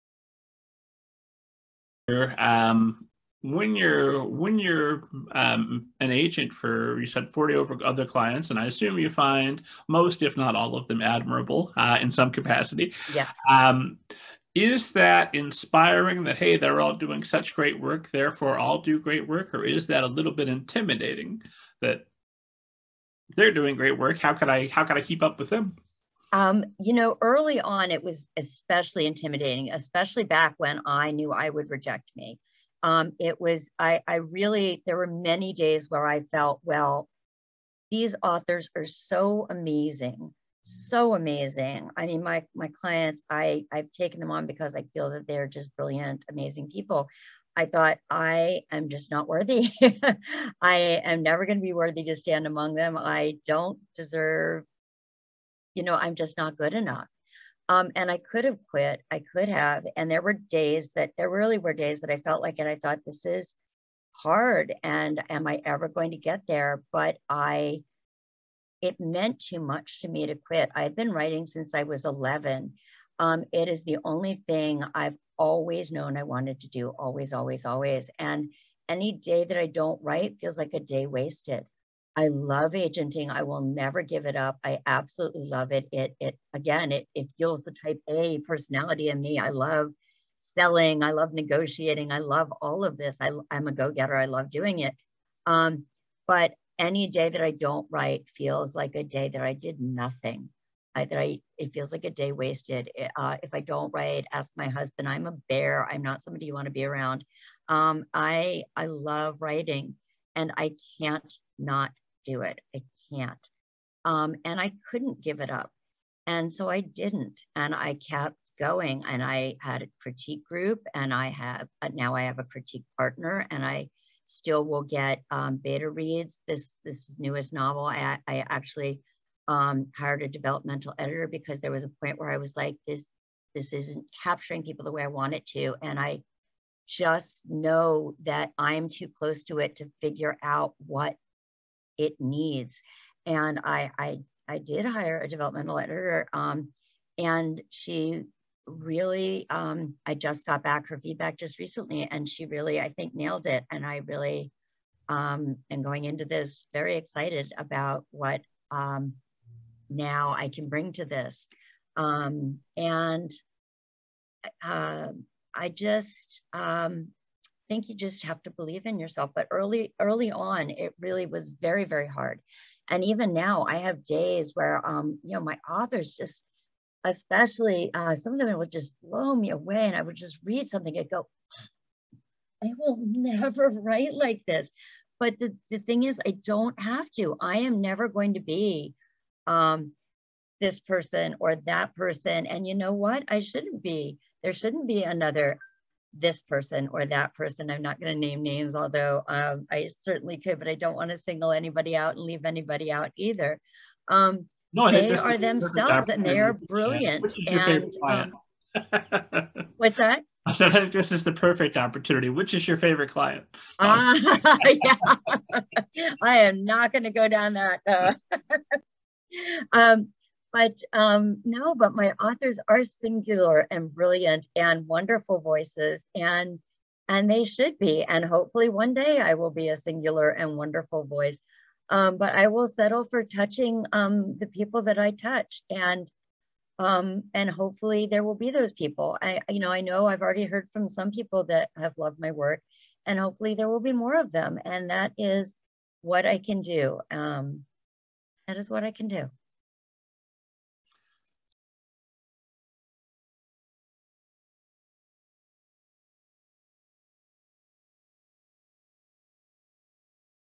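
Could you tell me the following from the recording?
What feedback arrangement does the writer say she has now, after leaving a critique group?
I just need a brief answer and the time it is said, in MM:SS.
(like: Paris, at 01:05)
A critique partner, at 02:02.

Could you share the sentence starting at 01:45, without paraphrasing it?
I'm not somebody you want to be around.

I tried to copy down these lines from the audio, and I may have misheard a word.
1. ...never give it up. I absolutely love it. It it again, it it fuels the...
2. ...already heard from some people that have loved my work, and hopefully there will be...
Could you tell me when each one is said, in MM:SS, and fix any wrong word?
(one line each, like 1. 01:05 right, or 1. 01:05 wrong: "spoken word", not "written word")
1. 01:23 right
2. 04:00 right.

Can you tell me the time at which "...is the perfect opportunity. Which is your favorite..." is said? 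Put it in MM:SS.
03:31.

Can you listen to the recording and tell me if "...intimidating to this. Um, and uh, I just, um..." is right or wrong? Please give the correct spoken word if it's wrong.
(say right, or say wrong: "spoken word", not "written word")
wrong: "bring", not "intimidating".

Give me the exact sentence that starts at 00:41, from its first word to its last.
I mean, my, my clients, I, I've taken them on because I feel that they're just brilliant, amazing people.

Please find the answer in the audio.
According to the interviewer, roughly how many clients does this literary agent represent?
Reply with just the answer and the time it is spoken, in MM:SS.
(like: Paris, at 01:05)
40, at 00:07.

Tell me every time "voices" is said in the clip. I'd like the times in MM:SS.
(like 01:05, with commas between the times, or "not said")
03:45, 03:51.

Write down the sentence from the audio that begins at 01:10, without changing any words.
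I've been writing since I was 11.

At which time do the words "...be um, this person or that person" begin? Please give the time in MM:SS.
03:08.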